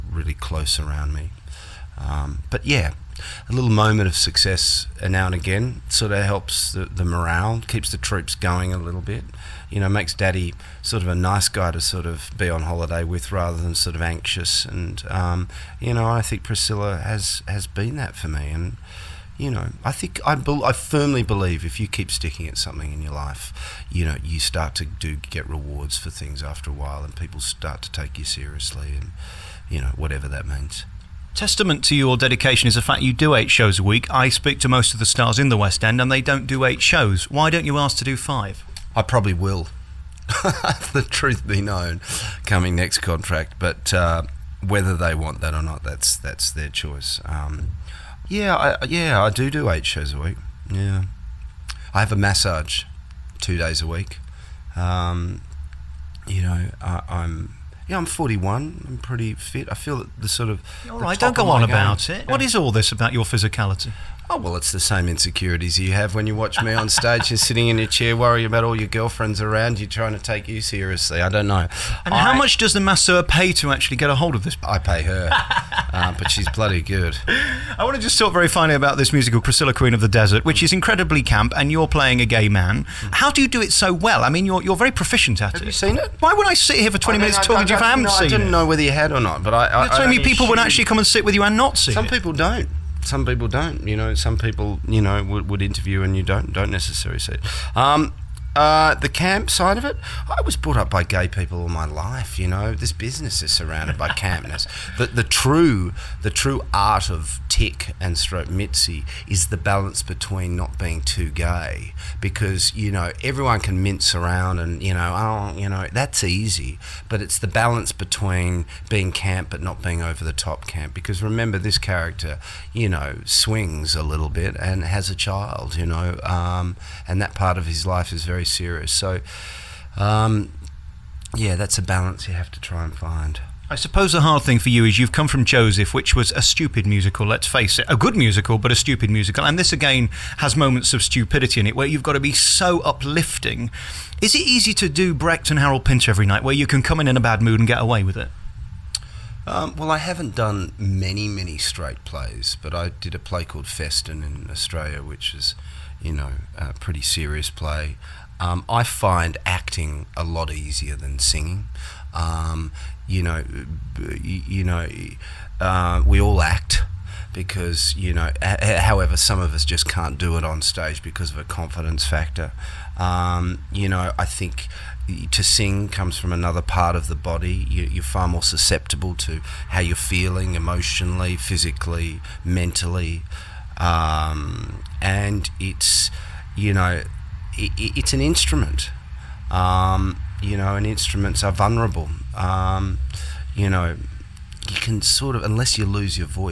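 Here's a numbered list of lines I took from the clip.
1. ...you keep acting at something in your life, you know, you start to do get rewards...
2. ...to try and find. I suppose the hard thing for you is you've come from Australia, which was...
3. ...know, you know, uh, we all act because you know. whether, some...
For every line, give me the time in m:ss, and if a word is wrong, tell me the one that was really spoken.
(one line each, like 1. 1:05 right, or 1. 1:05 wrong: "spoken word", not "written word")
1. 0:21 wrong: "sticking", not "acting"
2. 2:12 wrong: "Joseph", not "Australia"
3. 2:43 wrong: "however", not "whether".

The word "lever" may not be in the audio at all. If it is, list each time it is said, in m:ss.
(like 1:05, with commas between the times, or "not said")
not said.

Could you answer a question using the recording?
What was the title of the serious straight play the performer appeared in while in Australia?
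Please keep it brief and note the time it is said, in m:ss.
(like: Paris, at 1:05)
Festen, at 2:33.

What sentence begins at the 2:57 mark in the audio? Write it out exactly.
You, are far more susceptible to how you're feeling emotionally, physically, mentally, um, and it's you know it, it's an instrument.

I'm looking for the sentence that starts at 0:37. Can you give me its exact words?
Why don't you ask to do five?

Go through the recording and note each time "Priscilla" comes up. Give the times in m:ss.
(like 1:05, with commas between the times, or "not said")
0:16, 1:19.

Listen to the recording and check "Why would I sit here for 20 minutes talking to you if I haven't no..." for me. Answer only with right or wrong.
right.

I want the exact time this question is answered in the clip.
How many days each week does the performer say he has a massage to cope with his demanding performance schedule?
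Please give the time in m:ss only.
0:53.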